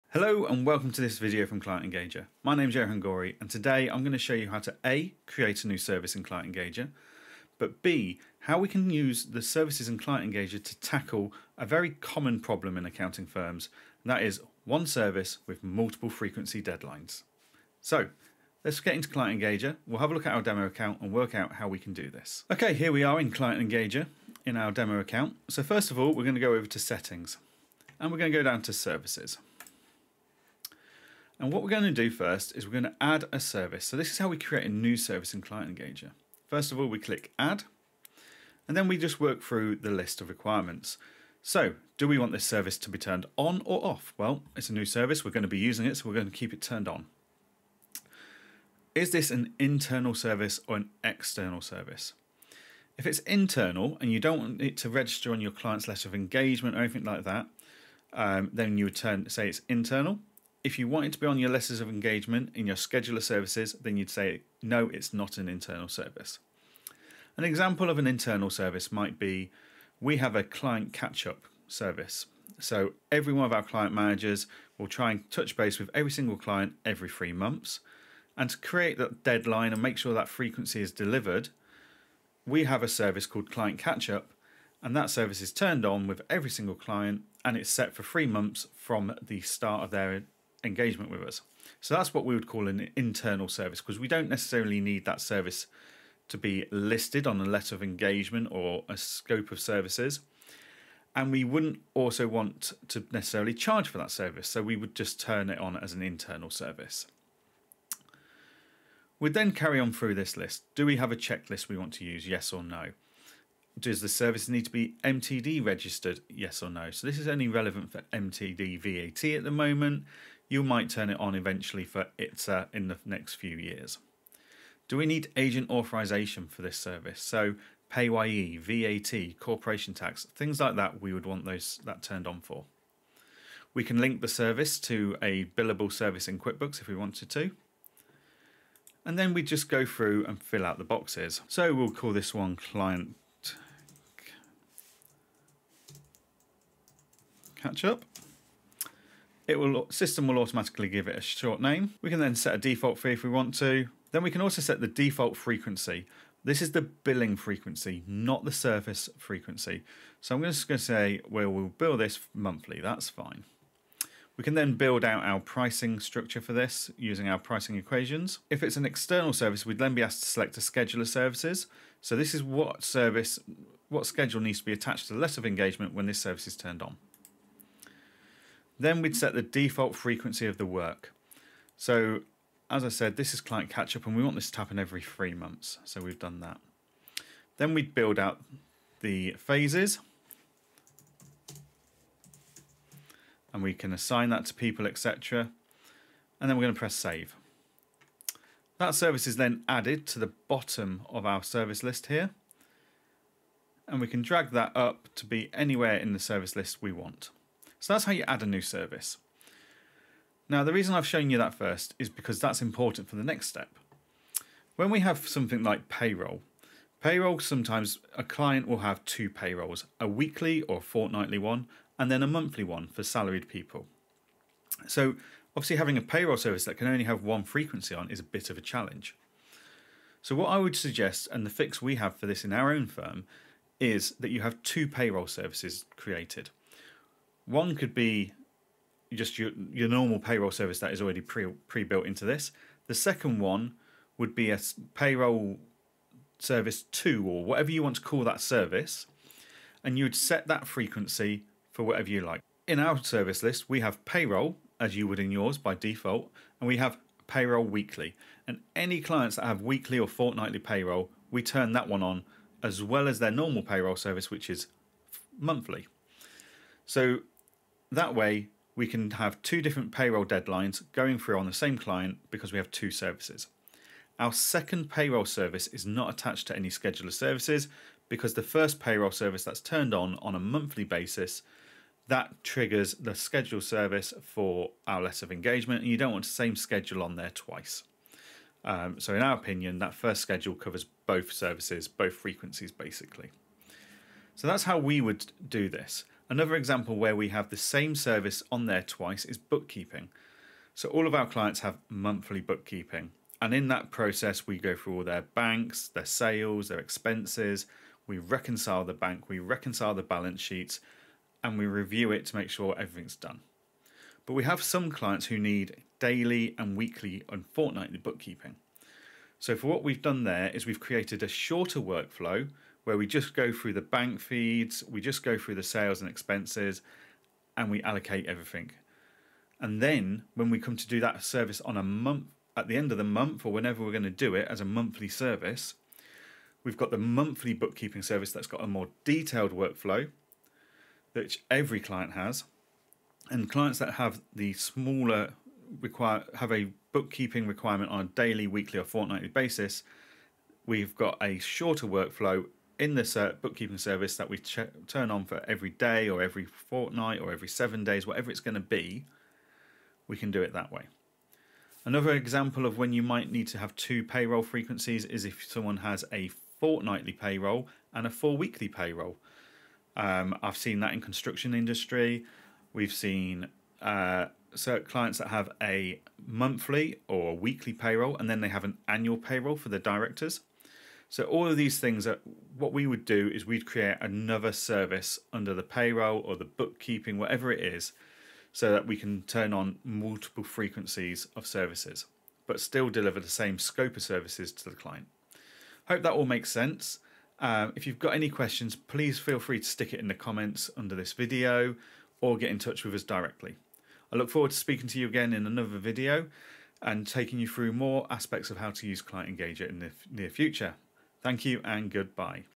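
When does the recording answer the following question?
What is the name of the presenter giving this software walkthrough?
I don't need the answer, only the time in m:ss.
0:02.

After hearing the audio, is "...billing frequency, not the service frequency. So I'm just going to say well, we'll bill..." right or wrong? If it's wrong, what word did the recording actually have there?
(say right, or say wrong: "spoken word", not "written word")
right.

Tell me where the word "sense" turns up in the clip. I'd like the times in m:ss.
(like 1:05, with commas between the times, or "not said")
6:36.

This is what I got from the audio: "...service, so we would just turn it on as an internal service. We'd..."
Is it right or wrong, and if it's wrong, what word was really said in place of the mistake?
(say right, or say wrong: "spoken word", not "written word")
right.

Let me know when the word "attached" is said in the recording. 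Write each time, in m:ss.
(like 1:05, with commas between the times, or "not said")
2:54, 4:36.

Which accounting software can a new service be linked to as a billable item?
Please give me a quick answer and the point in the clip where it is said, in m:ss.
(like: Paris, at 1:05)
QuickBooks, at 2:16.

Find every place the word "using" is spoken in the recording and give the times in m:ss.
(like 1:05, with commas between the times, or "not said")
0:45, 2:46.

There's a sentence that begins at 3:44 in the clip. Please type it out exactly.
So obviously having a payroll service that can only have one frequency on is a bit of a challenge.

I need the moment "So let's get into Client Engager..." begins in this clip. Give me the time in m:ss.
0:17.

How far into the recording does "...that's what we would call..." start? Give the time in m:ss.
1:31.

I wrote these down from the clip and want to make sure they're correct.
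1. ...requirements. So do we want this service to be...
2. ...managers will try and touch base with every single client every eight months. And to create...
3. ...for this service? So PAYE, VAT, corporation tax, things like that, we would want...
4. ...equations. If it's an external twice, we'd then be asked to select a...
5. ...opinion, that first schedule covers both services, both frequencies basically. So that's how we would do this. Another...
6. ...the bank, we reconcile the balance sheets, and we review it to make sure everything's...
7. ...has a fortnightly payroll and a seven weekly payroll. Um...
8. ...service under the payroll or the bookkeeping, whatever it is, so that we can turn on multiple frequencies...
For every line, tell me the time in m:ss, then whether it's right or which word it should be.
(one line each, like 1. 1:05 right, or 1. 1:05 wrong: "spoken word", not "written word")
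1. 0:40 right
2. 1:13 wrong: "three", not "eight"
3. 2:06 right
4. 2:47 wrong: "service", not "twice"
5. 4:49 right
6. 5:08 right
7. 6:05 wrong: "four", not "seven"
8. 6:24 right.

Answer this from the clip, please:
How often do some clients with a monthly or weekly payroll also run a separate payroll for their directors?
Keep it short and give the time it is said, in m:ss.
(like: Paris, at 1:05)
annual, at 6:18.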